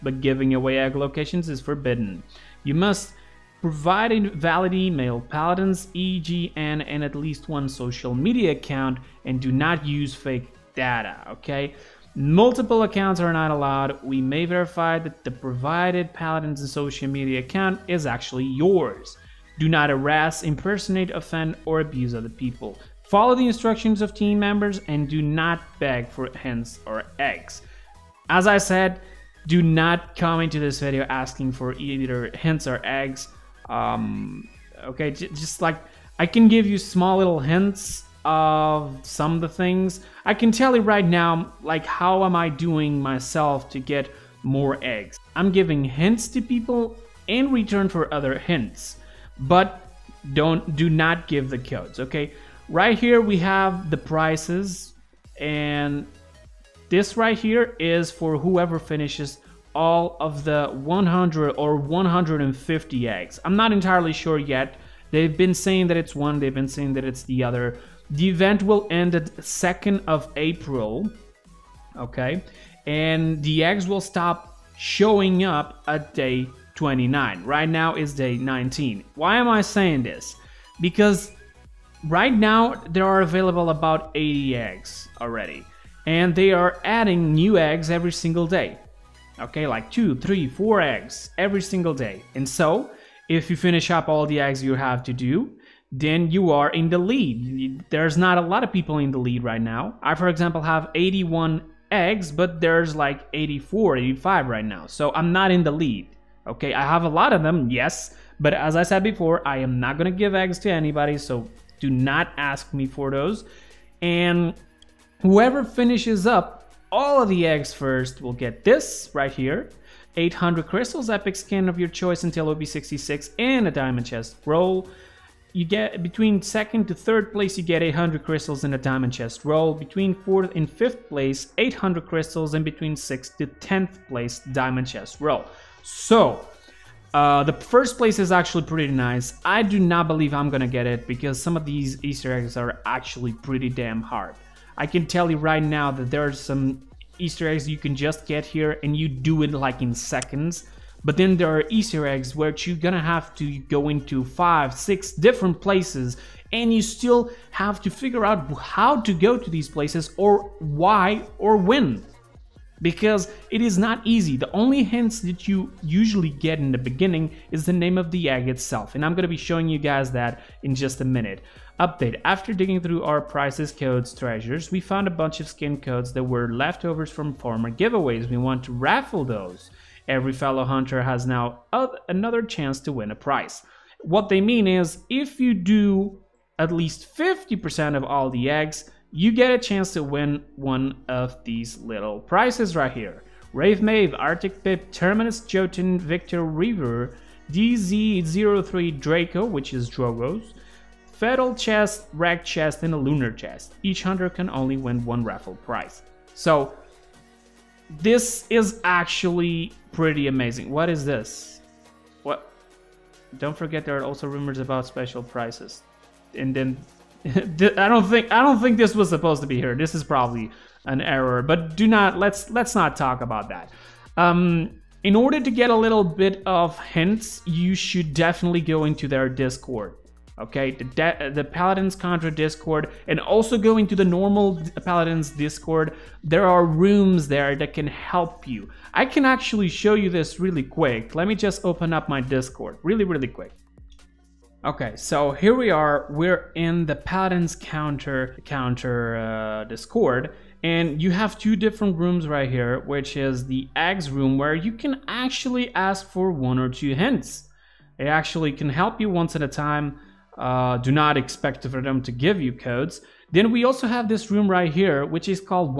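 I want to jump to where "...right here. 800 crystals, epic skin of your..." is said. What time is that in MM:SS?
01:59.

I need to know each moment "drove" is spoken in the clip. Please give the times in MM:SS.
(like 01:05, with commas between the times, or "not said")
not said.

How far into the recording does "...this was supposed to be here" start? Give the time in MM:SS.
03:38.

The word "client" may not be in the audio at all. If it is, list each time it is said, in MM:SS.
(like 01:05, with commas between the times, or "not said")
not said.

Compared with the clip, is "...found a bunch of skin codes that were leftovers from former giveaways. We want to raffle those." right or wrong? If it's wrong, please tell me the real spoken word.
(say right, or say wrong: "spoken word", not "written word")
right.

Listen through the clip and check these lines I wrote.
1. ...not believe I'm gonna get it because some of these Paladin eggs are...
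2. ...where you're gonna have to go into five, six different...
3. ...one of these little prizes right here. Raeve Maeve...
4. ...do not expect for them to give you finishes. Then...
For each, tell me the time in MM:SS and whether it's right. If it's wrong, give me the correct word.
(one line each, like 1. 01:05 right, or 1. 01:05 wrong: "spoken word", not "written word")
1. 02:19 wrong: "Easter", not "Paladin"
2. 02:32 right
3. 03:10 right
4. 04:20 wrong: "codes", not "finishes".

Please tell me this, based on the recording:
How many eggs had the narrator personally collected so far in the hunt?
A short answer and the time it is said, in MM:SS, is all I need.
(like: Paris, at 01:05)
81, at 01:40.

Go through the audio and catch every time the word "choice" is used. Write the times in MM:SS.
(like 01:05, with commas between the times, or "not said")
02:01.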